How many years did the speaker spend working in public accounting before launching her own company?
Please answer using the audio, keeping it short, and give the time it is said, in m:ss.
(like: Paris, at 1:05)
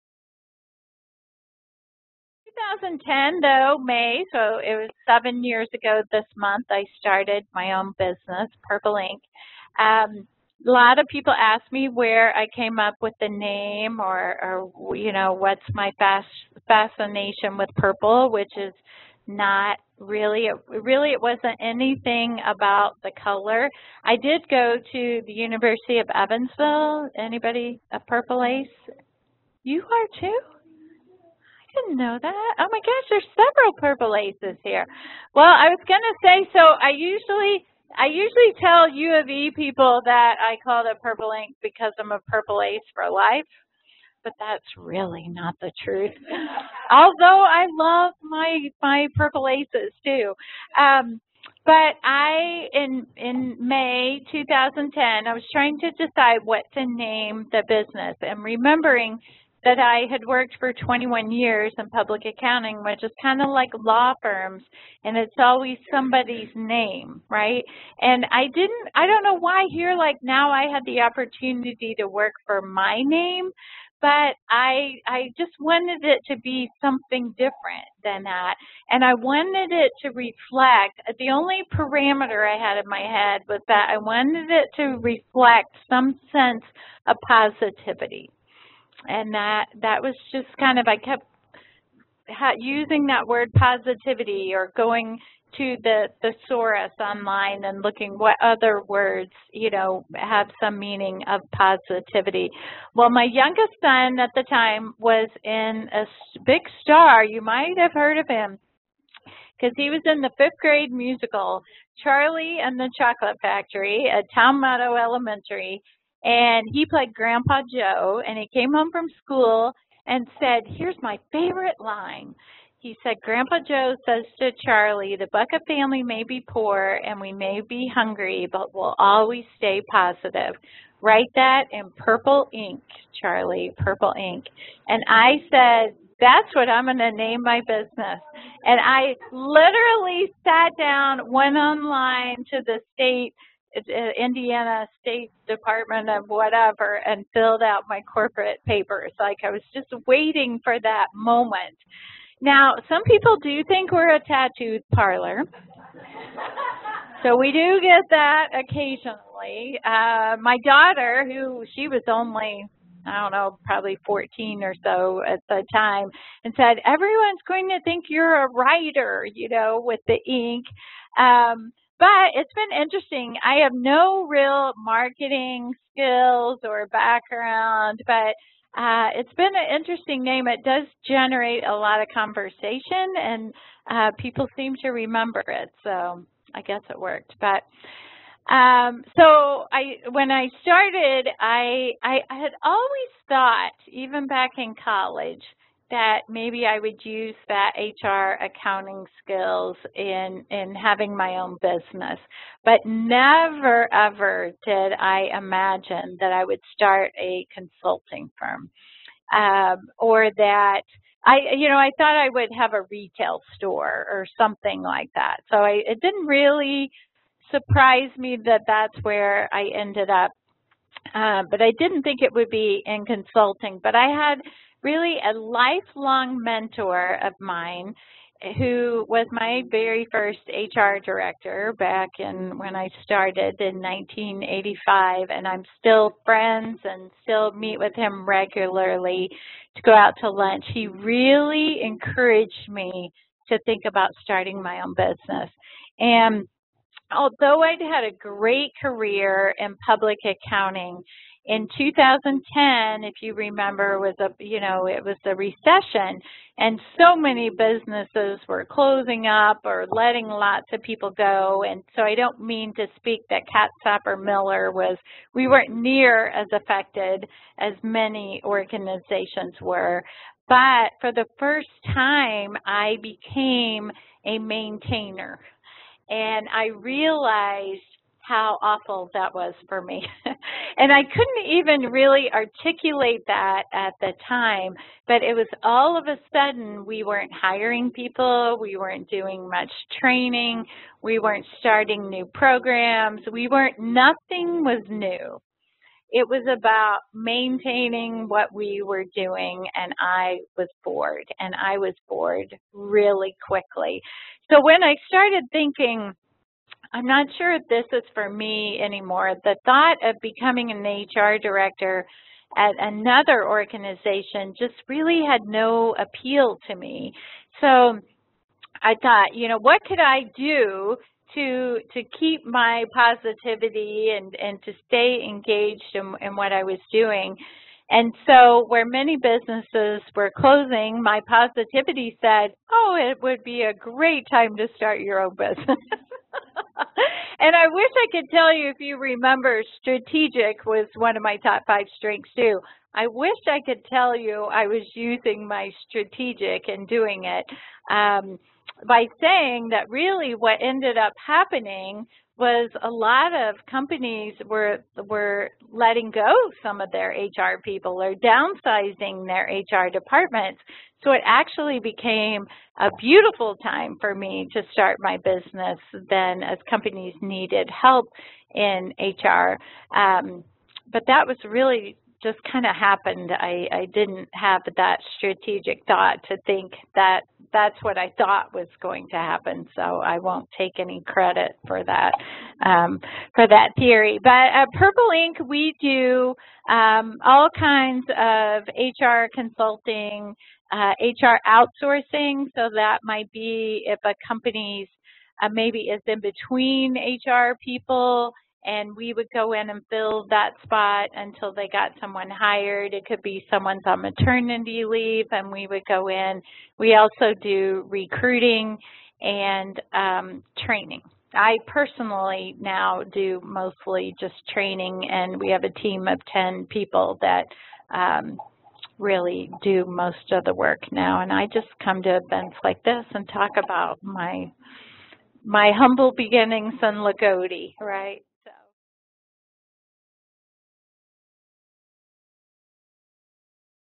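21, at 1:00.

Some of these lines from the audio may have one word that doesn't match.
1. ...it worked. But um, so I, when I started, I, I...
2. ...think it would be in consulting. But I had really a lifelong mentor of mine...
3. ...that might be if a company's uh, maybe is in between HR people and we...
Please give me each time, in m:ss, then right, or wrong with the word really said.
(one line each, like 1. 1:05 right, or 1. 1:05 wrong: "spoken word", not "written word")
1. 3:06 right
2. 3:42 right
3. 6:32 right.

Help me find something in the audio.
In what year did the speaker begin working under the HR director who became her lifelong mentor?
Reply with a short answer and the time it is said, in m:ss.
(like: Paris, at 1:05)
1985, at 3:53.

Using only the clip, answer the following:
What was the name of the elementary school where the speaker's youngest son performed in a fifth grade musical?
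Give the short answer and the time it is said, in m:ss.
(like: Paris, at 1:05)
Towne Meadow Elementary, at 1:54.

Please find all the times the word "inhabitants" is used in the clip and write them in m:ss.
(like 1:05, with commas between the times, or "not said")
not said.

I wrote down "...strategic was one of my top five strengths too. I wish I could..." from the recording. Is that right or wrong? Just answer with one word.
right.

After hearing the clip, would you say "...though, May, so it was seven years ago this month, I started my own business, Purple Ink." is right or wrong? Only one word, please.
right.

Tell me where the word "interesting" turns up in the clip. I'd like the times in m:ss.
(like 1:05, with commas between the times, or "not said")
2:52, 2:59.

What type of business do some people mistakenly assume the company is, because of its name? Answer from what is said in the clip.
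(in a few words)
A tattoo parlor.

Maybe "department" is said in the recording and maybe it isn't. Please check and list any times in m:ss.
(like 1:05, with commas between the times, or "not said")
2:25, 5:59.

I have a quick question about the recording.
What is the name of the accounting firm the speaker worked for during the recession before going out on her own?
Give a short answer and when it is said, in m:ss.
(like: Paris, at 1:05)
Katz Sapper Miller, at 4:23.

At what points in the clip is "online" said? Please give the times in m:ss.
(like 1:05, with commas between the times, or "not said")
1:36, 2:21.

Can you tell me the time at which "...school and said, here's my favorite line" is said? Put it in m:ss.
1:59.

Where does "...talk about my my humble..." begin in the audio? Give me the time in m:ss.
7:03.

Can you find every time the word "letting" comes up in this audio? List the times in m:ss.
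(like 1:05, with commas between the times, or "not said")
4:19, 5:55.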